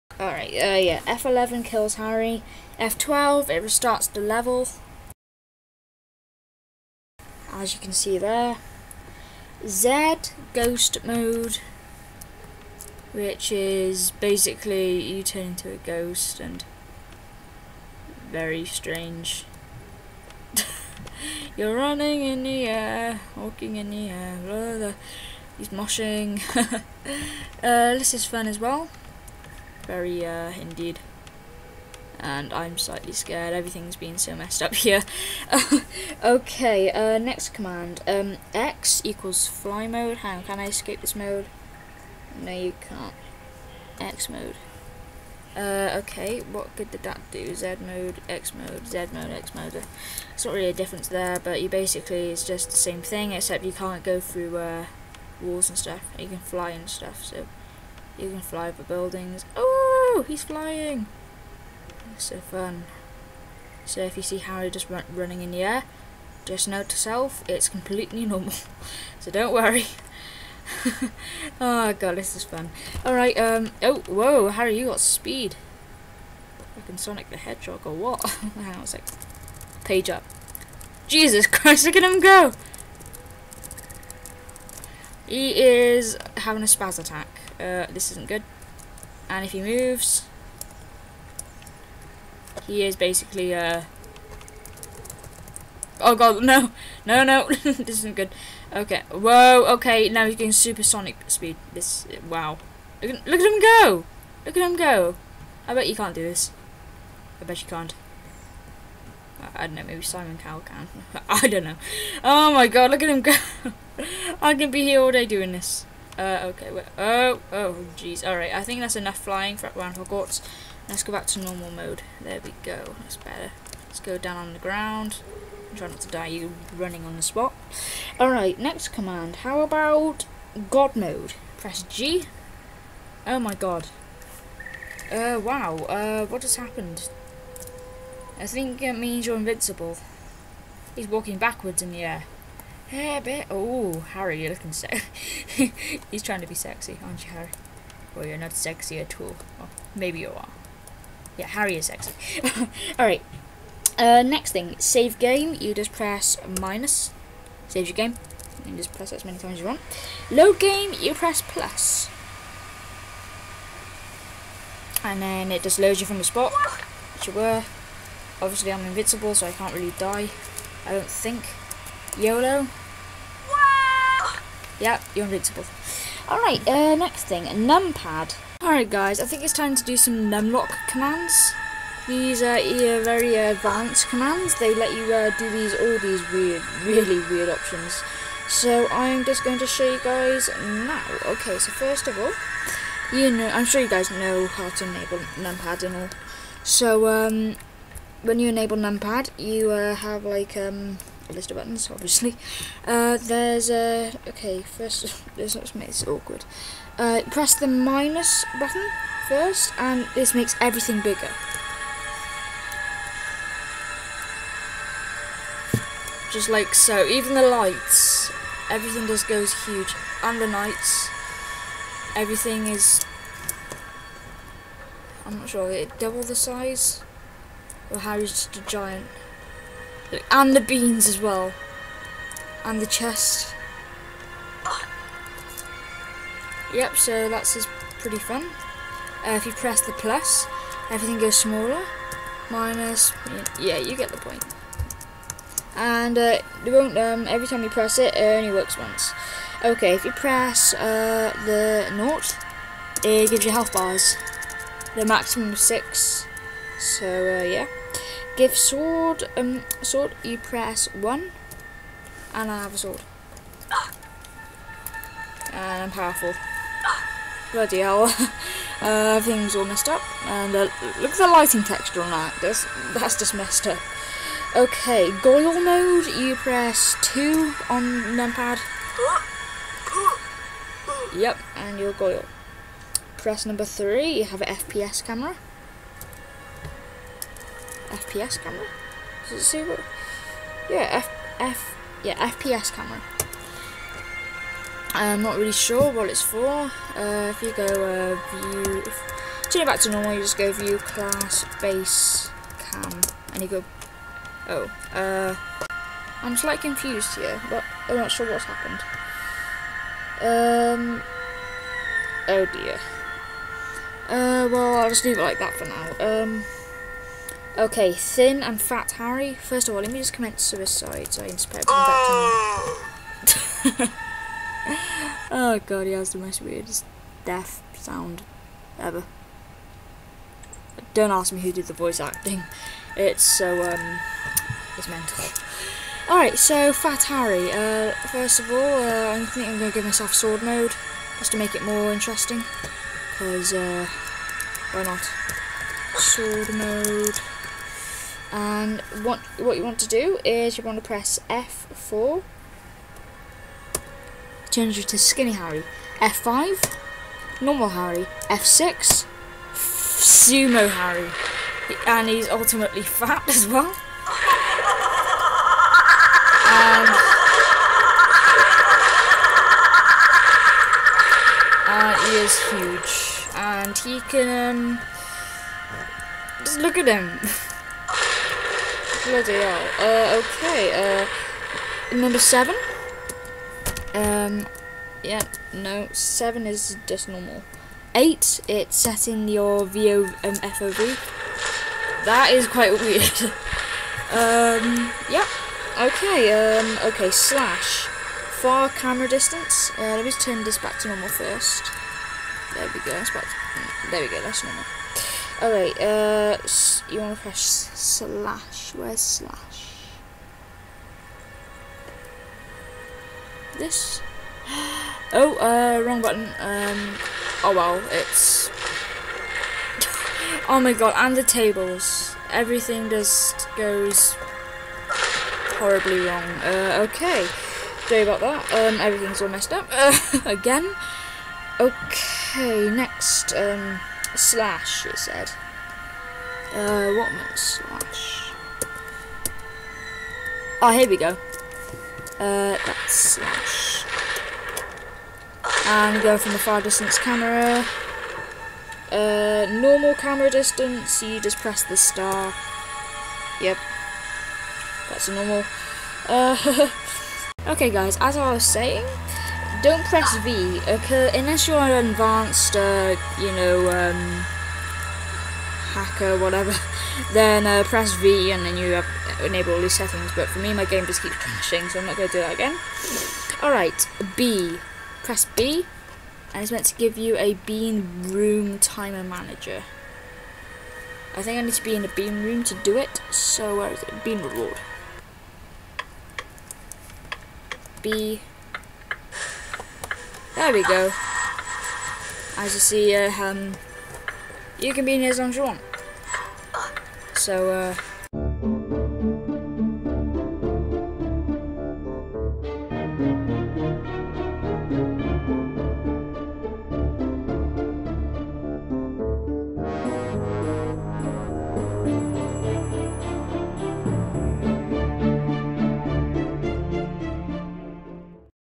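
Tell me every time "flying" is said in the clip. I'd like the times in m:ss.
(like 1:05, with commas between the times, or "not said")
1:00, 1:59.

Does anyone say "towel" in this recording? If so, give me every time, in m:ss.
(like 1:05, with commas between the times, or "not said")
not said.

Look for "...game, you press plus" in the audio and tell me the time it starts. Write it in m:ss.
2:40.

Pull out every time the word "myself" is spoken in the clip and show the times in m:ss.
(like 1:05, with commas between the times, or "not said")
5:39.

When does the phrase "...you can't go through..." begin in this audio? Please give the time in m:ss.
0:53.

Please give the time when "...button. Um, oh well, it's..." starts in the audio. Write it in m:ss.
6:56.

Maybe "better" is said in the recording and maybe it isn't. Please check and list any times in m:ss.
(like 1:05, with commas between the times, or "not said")
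2:03.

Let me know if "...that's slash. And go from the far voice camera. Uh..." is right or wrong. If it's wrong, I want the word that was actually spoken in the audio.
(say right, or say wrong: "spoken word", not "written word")
wrong: "distance", not "voice".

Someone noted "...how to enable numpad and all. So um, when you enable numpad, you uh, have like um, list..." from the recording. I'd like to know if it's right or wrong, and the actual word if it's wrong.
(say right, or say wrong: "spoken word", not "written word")
right.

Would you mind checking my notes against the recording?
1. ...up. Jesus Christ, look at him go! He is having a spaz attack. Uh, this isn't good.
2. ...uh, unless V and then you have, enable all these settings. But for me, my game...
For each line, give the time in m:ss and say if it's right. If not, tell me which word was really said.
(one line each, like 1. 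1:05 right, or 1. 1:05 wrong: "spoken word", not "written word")
1. 1:20 right
2. 7:47 wrong: "press", not "unless".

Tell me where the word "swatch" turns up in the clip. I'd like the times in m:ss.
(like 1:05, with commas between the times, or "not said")
not said.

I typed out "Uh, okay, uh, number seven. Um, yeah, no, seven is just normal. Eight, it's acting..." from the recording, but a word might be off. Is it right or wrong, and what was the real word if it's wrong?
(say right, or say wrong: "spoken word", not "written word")
wrong: "setting", not "acting".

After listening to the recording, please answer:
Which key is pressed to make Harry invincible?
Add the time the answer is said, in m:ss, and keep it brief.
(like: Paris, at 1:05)
G, at 2:11.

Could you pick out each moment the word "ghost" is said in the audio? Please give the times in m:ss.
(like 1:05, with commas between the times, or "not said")
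0:10, 0:15.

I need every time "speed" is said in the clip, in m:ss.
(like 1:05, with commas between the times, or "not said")
1:14, 1:41.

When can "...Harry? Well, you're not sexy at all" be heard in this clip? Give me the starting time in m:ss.
2:27.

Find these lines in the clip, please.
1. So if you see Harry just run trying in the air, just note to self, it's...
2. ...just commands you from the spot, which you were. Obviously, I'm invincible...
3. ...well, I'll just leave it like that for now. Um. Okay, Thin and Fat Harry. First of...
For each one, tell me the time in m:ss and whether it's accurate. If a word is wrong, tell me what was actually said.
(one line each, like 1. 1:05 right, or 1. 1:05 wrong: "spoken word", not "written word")
1. 1:03 wrong: "running", not "trying"
2. 2:45 wrong: "loads", not "commands"
3. 5:14 right.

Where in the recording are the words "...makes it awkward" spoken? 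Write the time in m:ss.
3:25.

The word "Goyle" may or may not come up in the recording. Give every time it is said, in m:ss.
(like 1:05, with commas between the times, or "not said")
4:35, 4:41.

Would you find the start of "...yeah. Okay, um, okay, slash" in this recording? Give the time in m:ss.
6:35.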